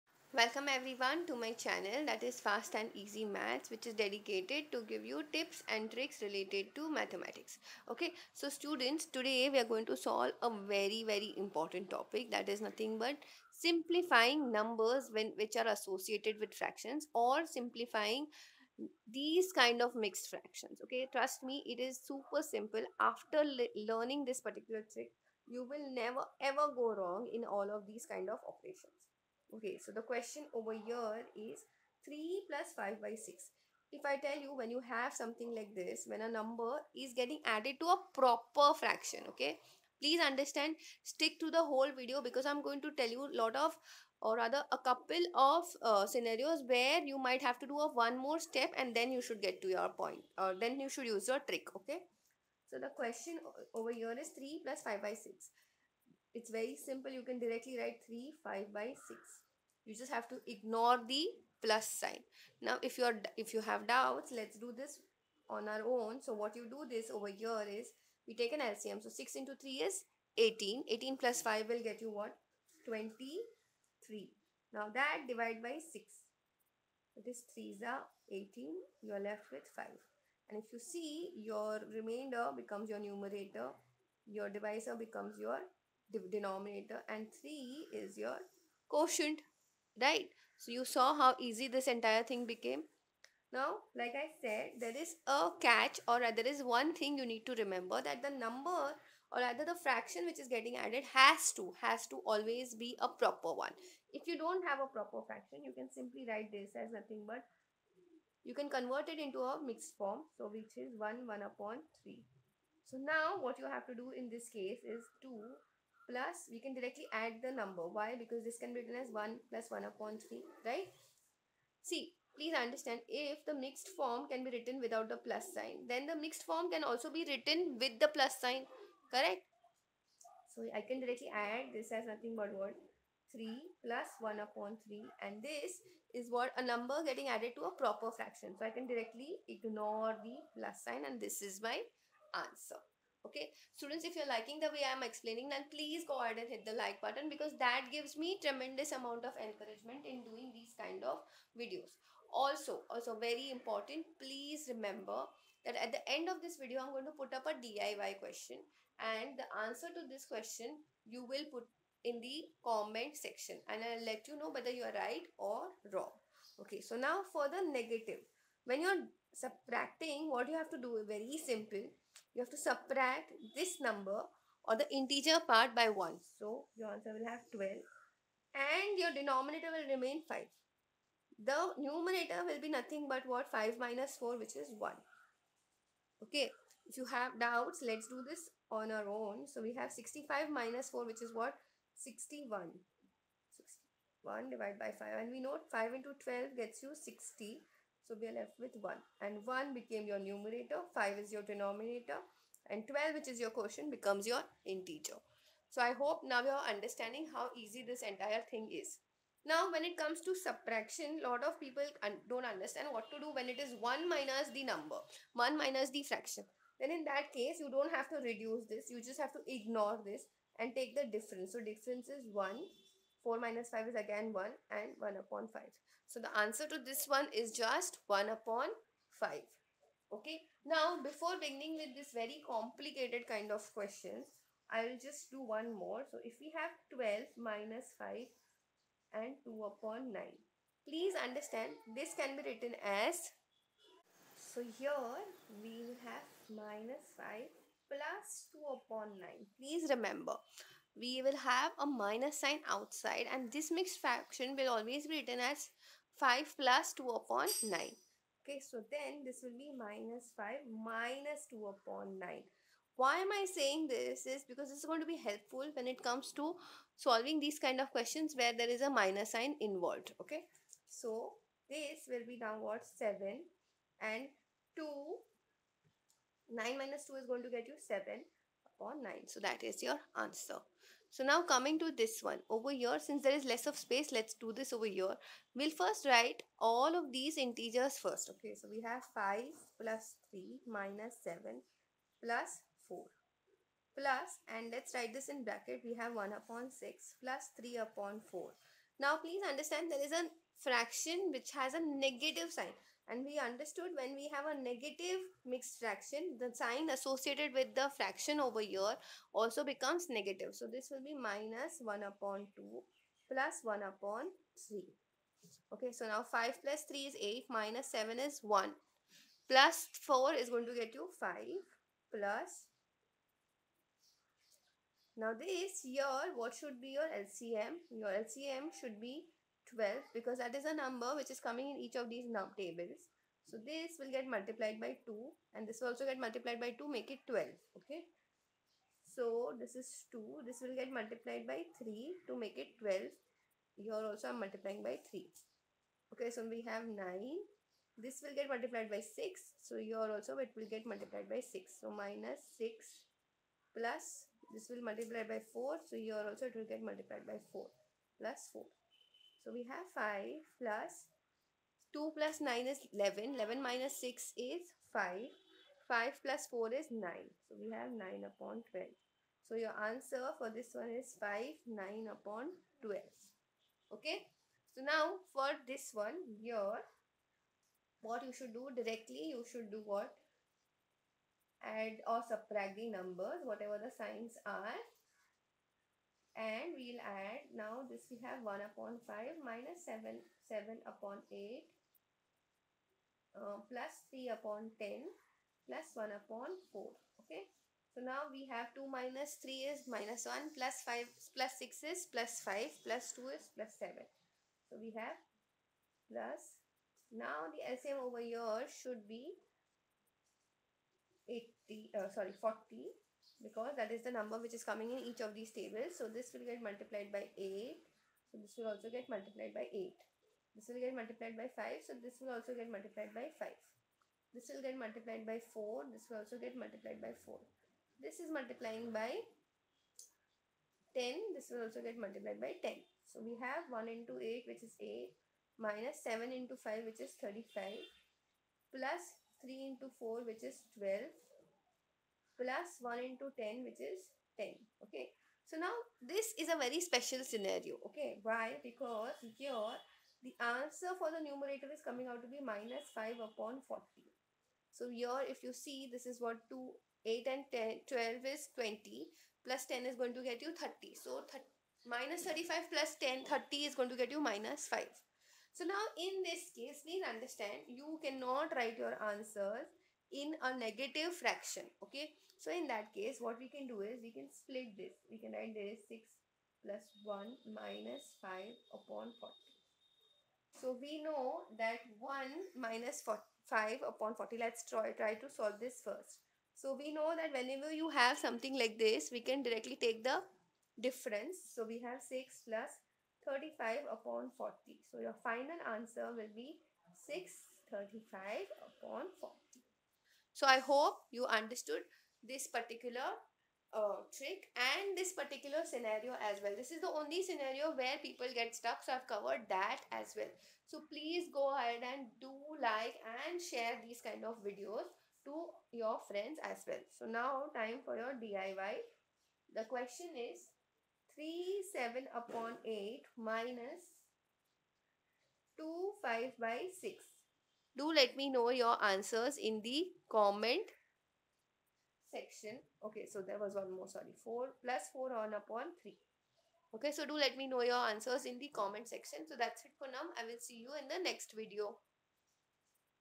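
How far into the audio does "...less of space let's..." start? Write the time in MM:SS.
04:43.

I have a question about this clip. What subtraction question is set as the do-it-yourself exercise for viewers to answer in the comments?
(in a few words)
3 7/8 minus 2 5/6.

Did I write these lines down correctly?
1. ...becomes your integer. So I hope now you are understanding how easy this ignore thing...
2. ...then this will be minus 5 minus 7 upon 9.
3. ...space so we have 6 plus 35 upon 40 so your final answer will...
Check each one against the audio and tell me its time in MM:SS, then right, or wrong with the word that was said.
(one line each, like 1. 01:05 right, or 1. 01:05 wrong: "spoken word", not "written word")
1. 03:23 wrong: "entire", not "ignore"
2. 04:18 wrong: "2", not "7"
3. 08:10 wrong: "difference", not "space".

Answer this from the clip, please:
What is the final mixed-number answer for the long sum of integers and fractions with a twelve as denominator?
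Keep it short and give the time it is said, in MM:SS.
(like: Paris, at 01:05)
5 9/12, at 06:11.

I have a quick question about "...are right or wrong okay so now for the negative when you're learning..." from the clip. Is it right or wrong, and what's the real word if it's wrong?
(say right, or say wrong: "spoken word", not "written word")
wrong: "subtracting", not "learning".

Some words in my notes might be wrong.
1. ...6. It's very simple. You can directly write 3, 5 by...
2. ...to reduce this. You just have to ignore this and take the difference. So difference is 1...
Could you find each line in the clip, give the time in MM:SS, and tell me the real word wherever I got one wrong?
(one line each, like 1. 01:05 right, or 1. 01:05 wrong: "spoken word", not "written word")
1. 00:55 right
2. 03:38 right.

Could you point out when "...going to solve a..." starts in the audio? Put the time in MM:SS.
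00:09.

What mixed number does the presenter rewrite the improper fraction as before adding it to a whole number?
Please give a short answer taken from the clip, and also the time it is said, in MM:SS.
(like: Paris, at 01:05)
1 1/3, at 01:50.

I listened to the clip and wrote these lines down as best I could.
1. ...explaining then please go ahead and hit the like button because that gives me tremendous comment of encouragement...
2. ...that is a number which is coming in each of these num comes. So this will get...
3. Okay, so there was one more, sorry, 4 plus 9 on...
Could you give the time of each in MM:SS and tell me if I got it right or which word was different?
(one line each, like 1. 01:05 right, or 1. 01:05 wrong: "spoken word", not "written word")
1. 02:25 wrong: "amount", not "comment"
2. 05:30 wrong: "tables", not "comes"
3. 08:52 wrong: "4", not "9".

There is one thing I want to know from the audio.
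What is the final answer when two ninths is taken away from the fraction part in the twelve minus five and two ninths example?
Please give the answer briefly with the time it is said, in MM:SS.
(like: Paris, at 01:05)
7 and 7/9, at 04:37.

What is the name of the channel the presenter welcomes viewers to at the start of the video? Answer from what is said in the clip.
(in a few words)
Fast and Easy Maths.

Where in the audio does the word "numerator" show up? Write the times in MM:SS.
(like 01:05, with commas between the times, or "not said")
01:22, 03:01, 03:20, 07:31.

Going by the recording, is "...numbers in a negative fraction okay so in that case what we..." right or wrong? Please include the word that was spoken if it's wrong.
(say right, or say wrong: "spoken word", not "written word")
wrong: "answers", not "numbers".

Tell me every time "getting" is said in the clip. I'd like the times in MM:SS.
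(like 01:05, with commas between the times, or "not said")
00:37, 01:40, 02:17.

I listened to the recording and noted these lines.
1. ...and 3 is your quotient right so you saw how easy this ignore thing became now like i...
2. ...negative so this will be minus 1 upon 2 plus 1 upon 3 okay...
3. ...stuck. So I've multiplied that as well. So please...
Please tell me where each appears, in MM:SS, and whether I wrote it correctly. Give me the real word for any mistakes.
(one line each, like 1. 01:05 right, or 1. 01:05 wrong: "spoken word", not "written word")
1. 01:27 wrong: "entire", not "ignore"
2. 05:10 right
3. 08:28 wrong: "covered", not "multiplied".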